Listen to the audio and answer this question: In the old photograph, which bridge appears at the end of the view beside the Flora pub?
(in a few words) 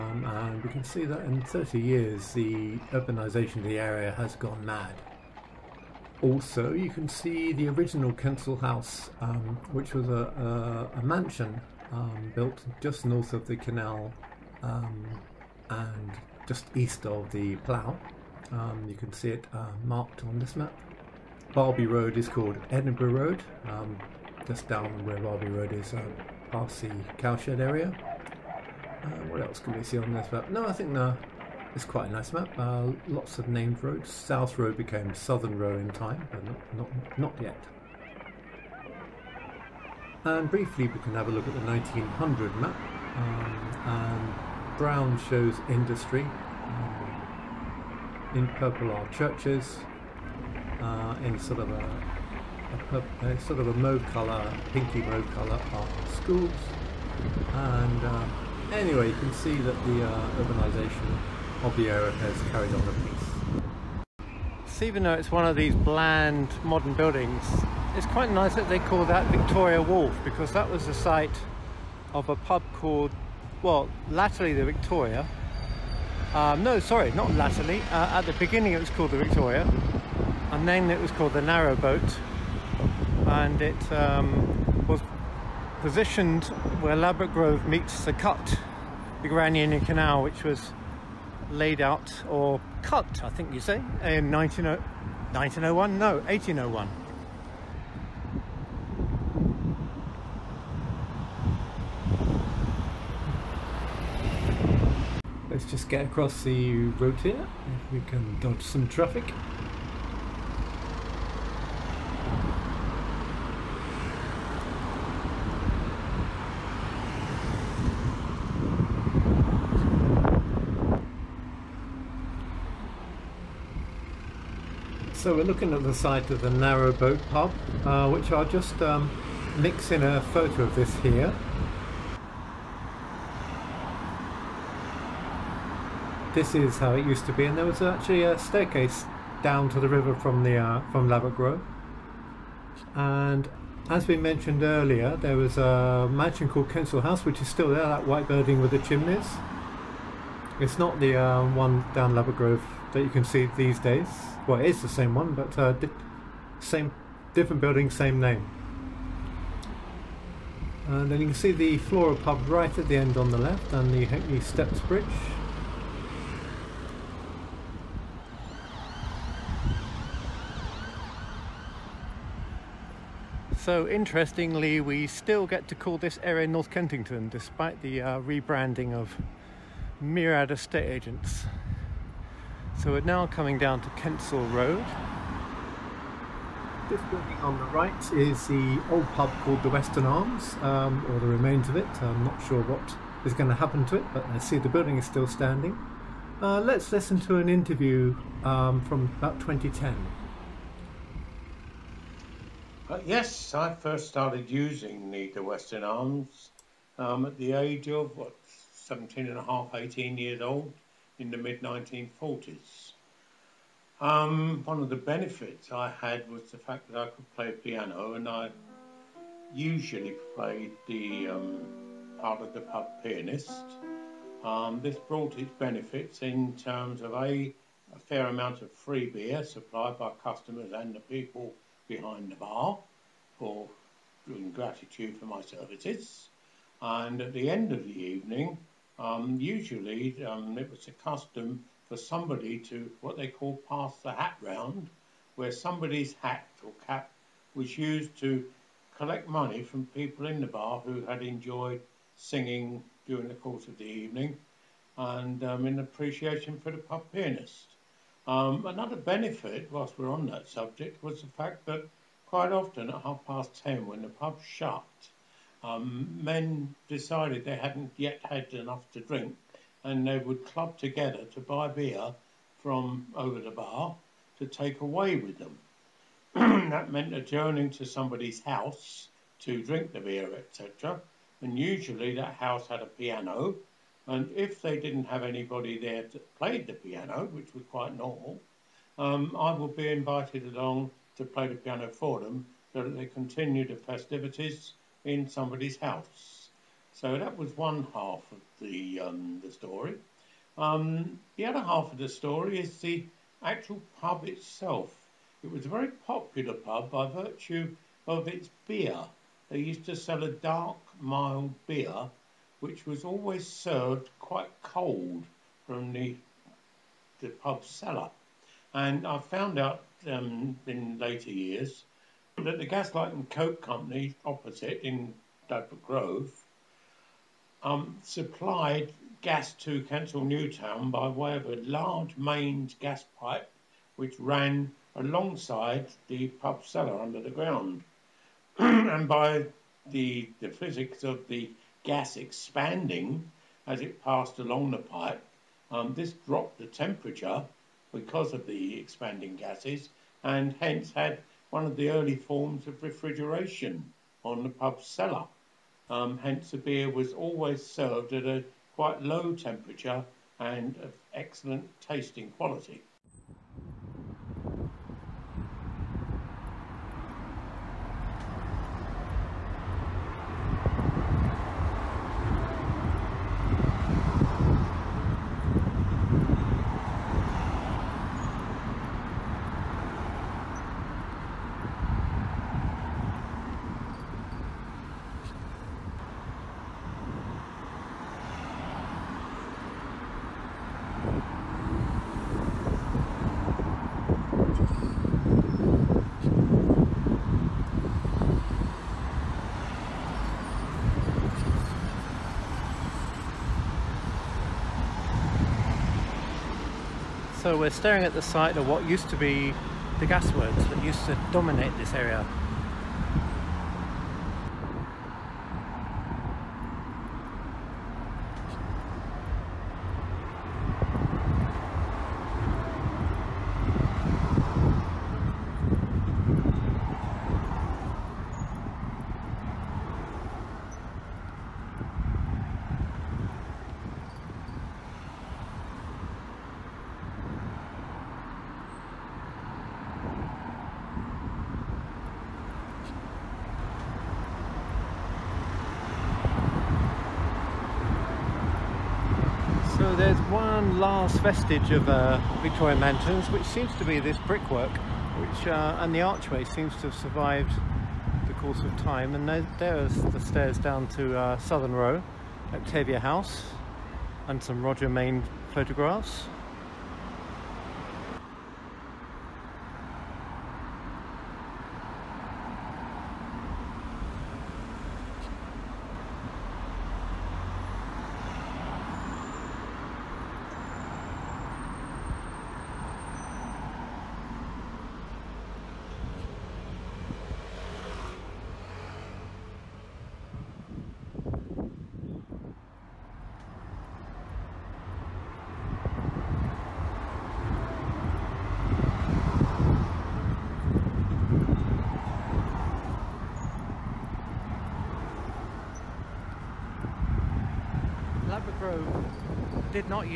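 Ha'penny Steps Bridge.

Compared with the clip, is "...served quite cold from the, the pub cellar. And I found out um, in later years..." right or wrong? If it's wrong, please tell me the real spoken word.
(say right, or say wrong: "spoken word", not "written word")
right.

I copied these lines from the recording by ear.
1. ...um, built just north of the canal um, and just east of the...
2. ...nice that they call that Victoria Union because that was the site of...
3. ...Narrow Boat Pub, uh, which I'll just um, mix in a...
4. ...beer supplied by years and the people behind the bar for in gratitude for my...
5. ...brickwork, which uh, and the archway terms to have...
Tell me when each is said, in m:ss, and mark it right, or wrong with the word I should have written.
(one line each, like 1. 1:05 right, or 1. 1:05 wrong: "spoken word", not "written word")
1. 0:11 right
2. 1:08 wrong: "Wharf", not "Union"
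3. 2:06 right
4. 3:49 wrong: "customers", not "years"
5. 7:34 wrong: "seems", not "terms".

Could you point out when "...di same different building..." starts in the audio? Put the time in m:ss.
2:35.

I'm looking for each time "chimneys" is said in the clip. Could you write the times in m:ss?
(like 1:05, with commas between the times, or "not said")
2:28.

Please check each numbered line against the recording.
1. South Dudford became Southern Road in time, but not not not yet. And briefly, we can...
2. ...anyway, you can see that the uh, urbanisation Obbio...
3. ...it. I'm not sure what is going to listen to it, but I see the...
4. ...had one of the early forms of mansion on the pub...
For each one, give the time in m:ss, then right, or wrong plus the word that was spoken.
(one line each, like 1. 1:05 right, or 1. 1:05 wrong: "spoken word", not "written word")
1. 0:34 wrong: "Road", not "Dudford"
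2. 0:58 right
3. 3:11 wrong: "happen", not "listen"
4. 5:50 wrong: "refrigeration", not "mansion".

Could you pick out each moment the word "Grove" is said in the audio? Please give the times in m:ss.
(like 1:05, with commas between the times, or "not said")
1:27, 2:21, 2:32, 5:25.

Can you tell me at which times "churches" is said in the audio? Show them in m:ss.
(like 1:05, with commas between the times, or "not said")
0:49.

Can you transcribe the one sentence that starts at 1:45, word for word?
Let's just get across the road here, if we can dodge some traffic.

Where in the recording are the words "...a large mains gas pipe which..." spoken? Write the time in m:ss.
5:31.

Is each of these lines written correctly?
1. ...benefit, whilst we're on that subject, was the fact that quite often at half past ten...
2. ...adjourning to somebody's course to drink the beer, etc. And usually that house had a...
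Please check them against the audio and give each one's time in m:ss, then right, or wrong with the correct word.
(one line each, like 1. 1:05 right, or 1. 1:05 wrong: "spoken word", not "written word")
1. 4:18 right
2. 4:37 wrong: "house", not "course".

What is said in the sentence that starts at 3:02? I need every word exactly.
So we're now coming down to Kensal Road.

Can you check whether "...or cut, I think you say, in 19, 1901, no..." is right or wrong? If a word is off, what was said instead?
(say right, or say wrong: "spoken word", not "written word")
right.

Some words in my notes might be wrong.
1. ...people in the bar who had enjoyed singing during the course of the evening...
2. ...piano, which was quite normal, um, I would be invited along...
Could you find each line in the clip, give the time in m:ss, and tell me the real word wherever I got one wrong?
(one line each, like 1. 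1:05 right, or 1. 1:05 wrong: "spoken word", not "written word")
1. 4:09 right
2. 4:46 right.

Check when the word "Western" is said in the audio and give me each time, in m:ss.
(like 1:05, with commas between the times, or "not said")
3:09, 3:25.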